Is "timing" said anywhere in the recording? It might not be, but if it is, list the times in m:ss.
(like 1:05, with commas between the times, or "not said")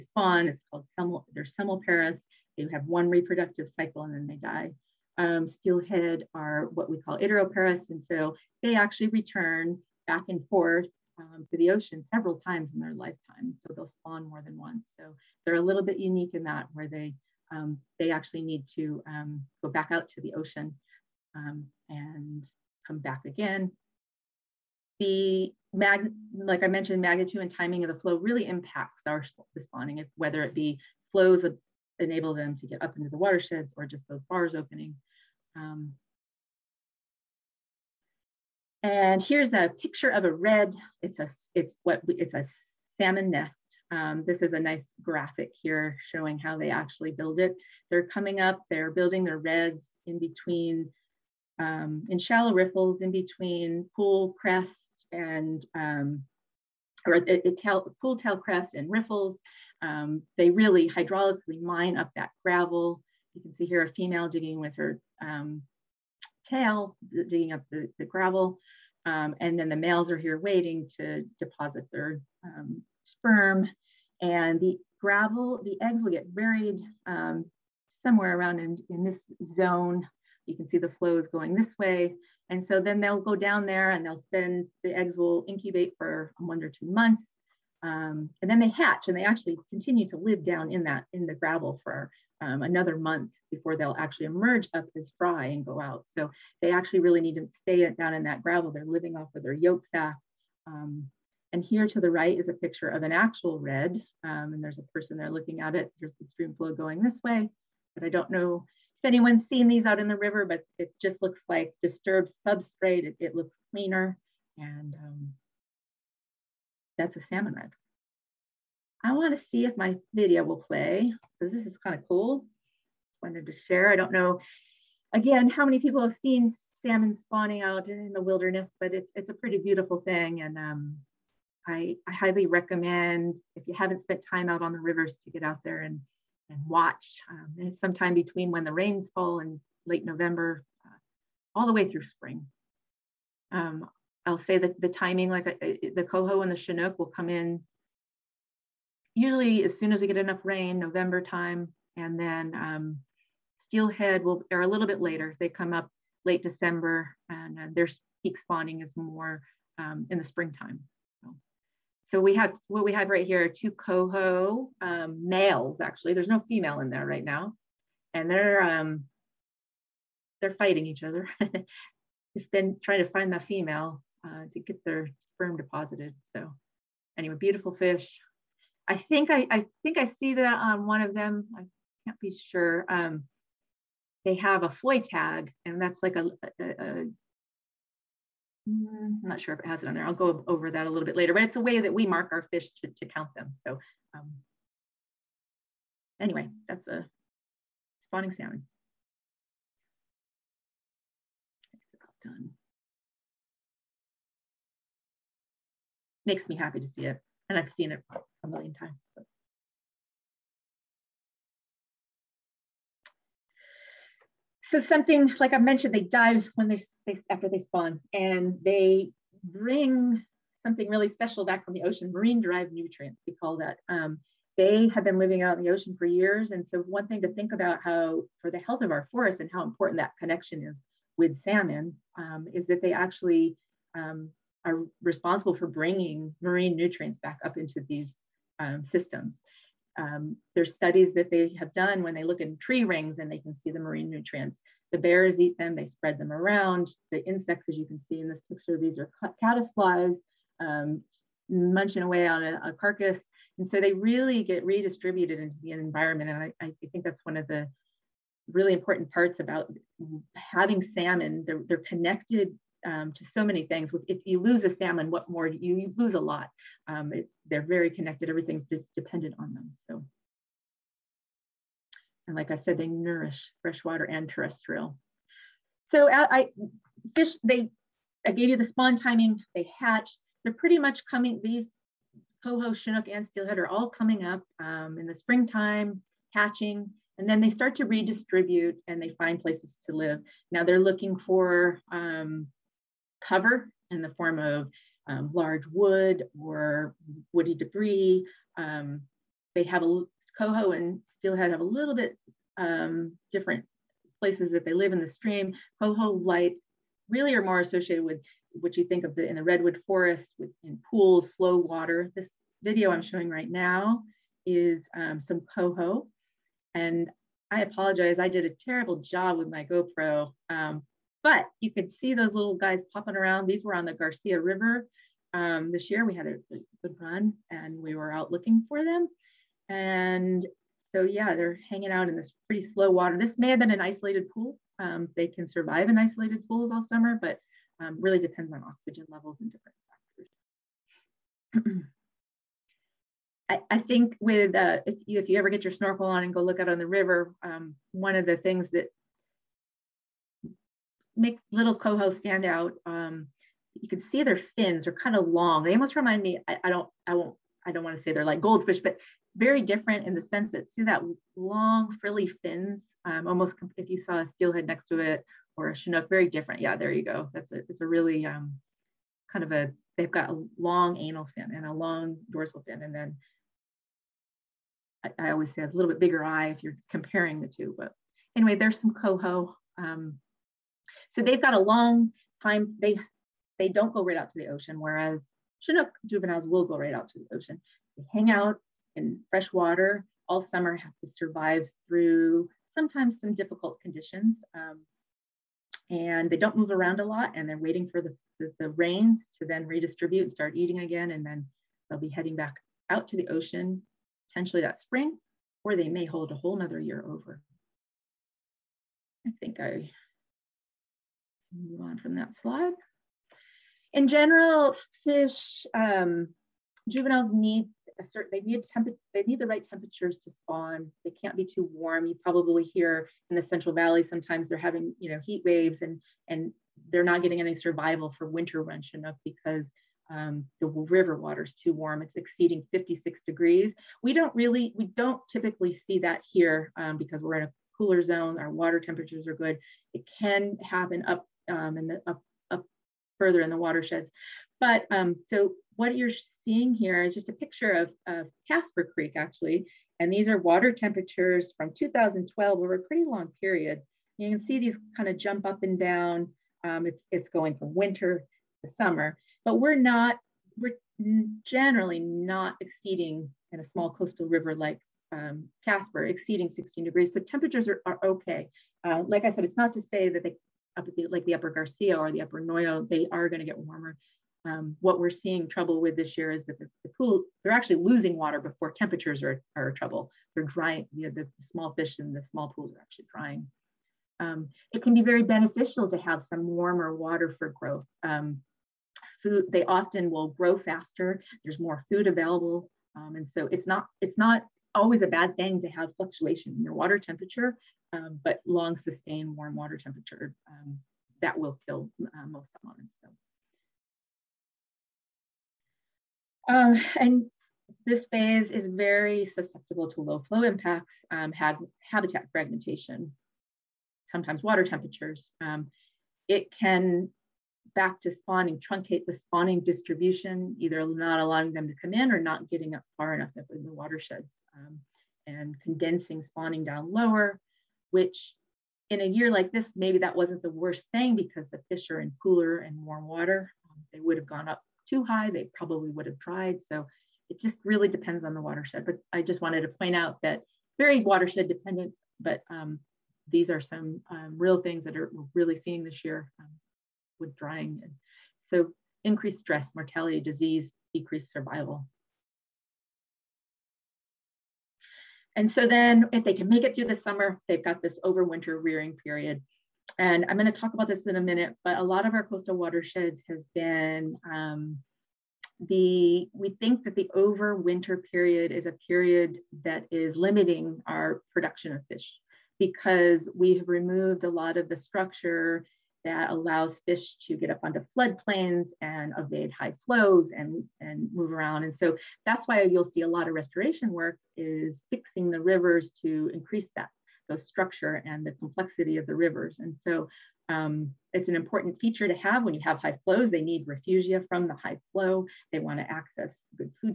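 0:27, 2:24, 4:38.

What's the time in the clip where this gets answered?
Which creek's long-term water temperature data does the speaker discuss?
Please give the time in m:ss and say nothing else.
7:28.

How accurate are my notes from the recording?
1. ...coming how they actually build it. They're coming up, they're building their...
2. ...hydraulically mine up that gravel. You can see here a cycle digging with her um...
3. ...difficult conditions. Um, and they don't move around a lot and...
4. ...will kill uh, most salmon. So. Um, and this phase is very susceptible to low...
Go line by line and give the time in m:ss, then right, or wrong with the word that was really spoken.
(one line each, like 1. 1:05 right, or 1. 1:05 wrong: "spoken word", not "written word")
1. 0:46 wrong: "showing", not "coming"
2. 1:00 wrong: "female", not "cycle"
3. 6:33 right
4. 8:21 right.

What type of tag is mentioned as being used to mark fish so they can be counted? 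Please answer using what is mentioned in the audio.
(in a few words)
floy tag.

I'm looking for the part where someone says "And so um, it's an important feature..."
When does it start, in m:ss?
9:49.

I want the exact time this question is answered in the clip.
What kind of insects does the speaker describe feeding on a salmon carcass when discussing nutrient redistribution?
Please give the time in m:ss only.
4:09.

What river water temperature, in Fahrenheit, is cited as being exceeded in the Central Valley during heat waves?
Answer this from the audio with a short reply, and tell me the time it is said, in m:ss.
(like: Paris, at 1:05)
56 degrees, at 7:12.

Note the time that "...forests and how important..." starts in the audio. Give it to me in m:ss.
3:49.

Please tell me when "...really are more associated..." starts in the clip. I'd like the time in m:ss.
5:07.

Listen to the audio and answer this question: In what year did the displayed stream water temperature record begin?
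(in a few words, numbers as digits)
2012.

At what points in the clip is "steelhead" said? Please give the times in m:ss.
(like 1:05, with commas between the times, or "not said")
0:05, 2:33, 4:43, 5:01, 6:04.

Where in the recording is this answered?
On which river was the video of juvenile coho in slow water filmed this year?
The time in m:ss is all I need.
5:23.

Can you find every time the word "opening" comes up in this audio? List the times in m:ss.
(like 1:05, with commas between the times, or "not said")
0:34.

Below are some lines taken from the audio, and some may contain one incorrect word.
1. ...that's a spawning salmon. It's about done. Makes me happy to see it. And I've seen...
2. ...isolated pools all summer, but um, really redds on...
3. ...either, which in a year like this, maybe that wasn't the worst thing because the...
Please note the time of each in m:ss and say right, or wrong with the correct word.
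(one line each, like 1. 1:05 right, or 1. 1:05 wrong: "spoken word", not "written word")
1. 3:16 right
2. 5:35 wrong: "depends", not "redds"
3. 8:46 wrong: "lower", not "either".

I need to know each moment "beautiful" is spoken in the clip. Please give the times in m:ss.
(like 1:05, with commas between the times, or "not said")
2:09, 2:57.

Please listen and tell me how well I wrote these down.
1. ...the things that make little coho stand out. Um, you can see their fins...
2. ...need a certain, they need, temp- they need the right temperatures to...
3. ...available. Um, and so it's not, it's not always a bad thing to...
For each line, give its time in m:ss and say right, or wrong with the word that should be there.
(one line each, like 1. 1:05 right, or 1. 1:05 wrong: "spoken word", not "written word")
1. 5:48 right
2. 6:57 right
3. 8:12 right.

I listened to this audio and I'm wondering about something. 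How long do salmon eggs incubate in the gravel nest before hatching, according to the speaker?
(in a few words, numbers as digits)
one or two months.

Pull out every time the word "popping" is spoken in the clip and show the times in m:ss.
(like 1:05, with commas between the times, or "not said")
5:22.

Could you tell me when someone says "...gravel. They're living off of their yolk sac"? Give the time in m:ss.
1:38.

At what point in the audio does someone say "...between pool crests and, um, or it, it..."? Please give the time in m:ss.
0:53.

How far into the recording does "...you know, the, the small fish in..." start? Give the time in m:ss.
8:00.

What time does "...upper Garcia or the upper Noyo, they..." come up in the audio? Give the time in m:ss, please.
7:51.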